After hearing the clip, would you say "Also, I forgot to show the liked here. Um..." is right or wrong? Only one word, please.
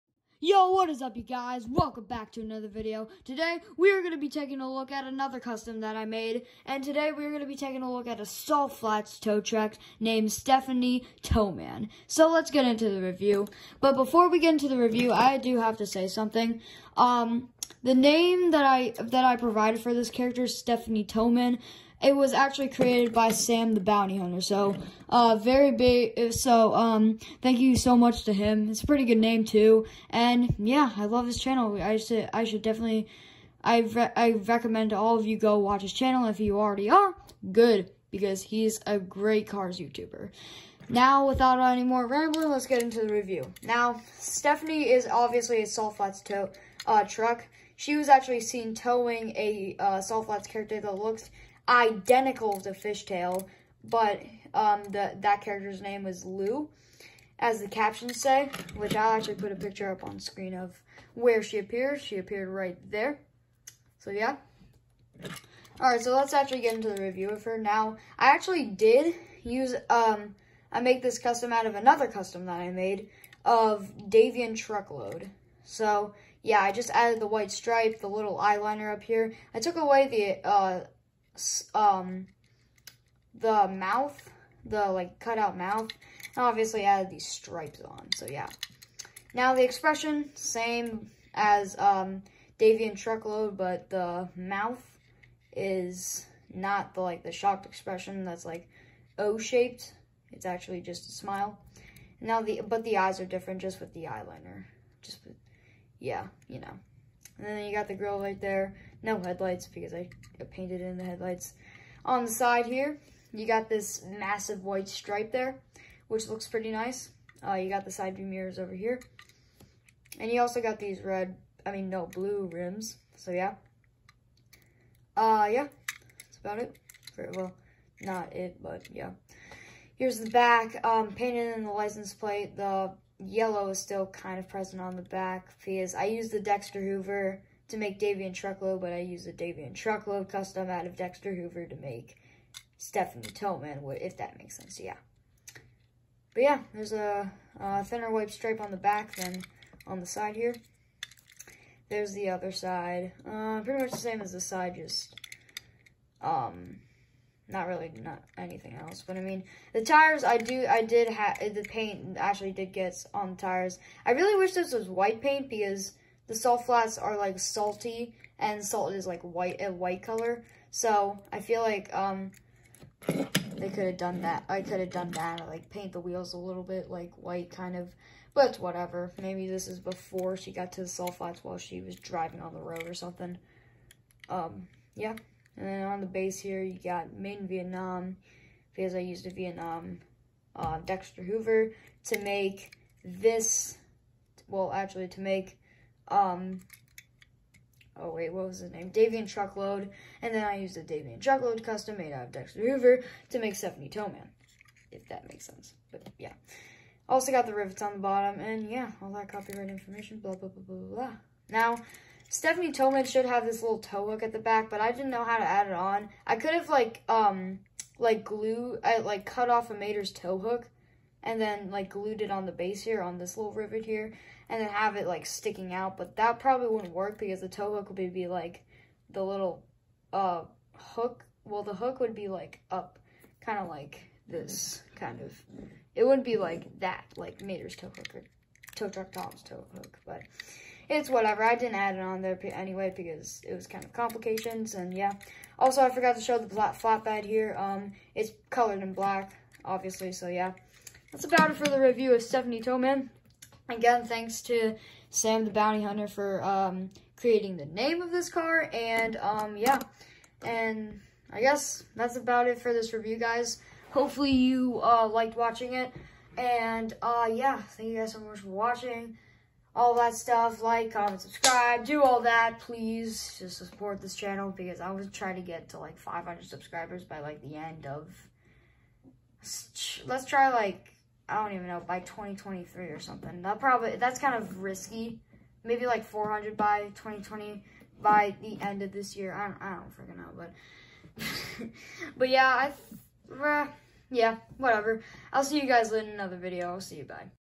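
wrong.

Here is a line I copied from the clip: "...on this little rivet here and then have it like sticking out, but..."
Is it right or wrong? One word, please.
right.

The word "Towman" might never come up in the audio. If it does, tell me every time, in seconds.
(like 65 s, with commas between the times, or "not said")
11 s, 21 s, 143 s, 203 s, 212 s, 252 s.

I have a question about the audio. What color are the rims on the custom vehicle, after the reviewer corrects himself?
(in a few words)
Blue.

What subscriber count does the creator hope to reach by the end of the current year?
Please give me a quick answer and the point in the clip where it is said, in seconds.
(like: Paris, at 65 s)
400, at 286 s.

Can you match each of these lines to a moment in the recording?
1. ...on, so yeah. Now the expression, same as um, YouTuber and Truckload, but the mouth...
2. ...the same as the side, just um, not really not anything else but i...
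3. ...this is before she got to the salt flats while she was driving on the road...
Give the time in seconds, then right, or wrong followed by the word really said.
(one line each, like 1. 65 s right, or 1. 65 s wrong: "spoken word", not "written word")
1. 87 s wrong: "Davy", not "YouTuber"
2. 153 s right
3. 179 s right.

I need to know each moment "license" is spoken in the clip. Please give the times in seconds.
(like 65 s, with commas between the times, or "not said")
131 s.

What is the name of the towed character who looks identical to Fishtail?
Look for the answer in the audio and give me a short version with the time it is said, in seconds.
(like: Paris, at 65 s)
Lou, at 56 s.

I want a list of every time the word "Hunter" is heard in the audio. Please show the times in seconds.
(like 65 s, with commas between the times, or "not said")
24 s, 255 s.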